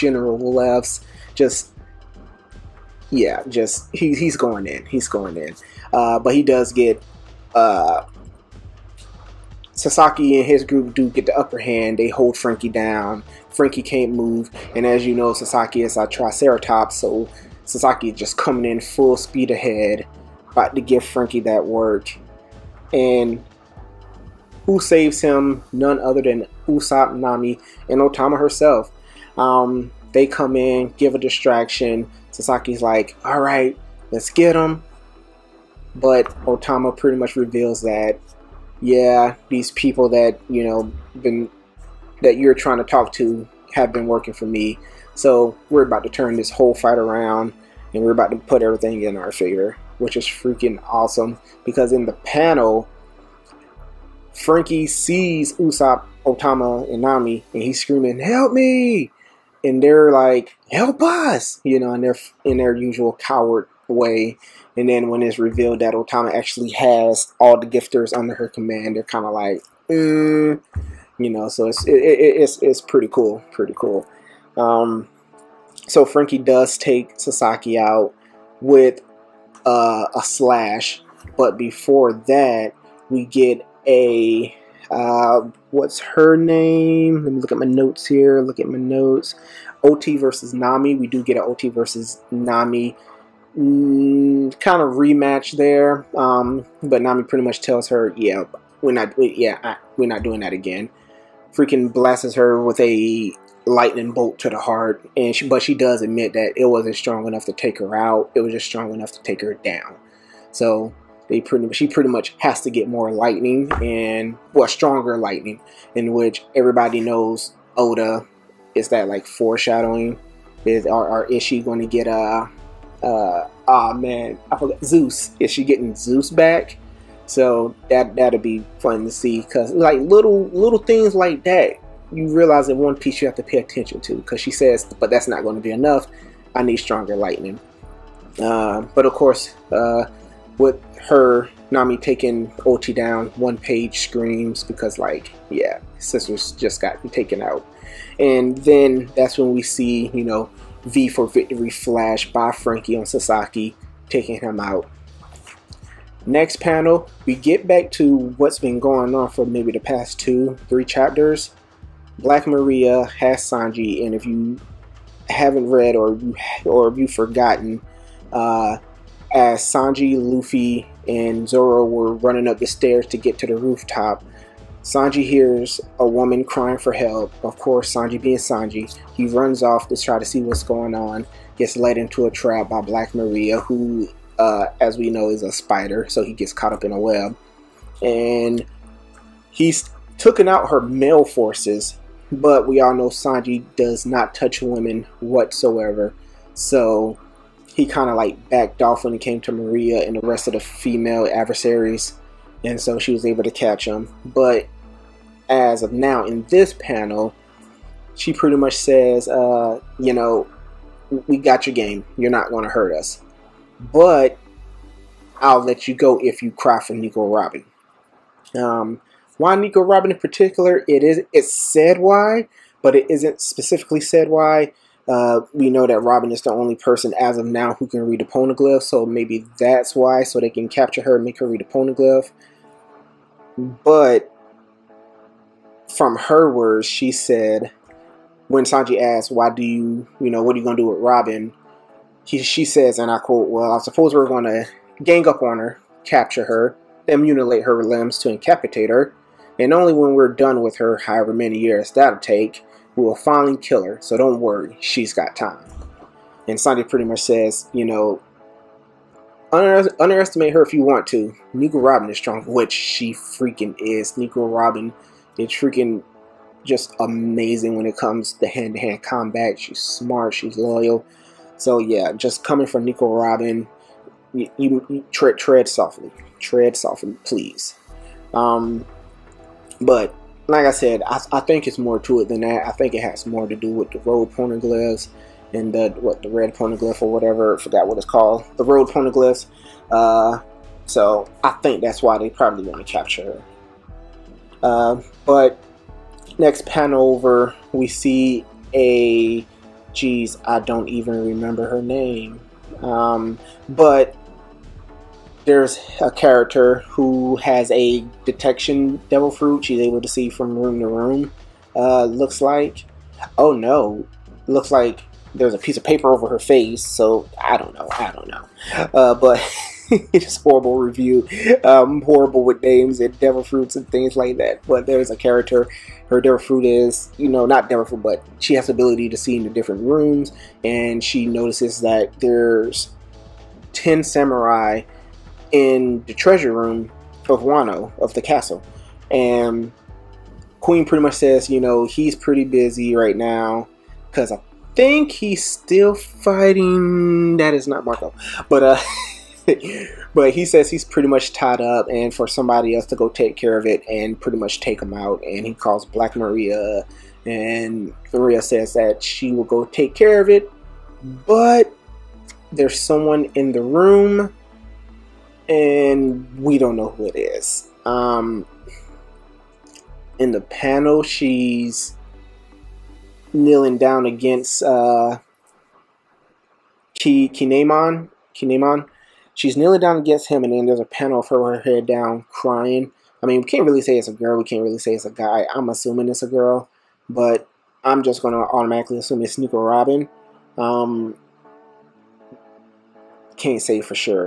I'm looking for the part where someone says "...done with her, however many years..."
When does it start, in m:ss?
4:10.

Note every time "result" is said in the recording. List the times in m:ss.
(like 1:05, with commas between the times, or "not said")
not said.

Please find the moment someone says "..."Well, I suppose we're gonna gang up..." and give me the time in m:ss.
4:03.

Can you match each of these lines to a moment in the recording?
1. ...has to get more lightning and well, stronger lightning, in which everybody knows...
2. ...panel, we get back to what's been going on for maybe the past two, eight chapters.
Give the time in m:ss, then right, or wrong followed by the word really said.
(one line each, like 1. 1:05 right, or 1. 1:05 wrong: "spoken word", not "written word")
1. 1:52 right
2. 2:36 wrong: "three", not "eight".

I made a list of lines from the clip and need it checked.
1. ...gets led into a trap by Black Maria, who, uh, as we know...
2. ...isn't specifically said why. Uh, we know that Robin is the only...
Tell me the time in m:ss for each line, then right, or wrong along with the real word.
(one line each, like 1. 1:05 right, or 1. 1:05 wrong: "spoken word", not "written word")
1. 3:01 right
2. 3:43 right.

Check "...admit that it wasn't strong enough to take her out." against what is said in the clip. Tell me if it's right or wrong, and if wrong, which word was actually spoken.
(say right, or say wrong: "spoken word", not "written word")
right.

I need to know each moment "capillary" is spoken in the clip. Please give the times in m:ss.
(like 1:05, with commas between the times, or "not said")
not said.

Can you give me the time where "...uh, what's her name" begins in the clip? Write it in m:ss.
1:24.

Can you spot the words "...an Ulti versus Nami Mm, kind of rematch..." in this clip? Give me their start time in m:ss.
1:31.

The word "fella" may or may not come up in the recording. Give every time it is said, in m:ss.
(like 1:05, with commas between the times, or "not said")
not said.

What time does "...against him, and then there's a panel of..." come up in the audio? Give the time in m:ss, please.
6:19.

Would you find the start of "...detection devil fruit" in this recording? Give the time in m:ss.
5:08.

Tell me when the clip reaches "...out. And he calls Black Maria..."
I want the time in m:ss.
5:54.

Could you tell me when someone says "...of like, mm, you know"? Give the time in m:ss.
1:09.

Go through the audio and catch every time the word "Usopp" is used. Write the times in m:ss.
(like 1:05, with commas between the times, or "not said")
0:26, 0:55.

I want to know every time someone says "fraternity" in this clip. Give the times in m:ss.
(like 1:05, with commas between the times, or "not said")
not said.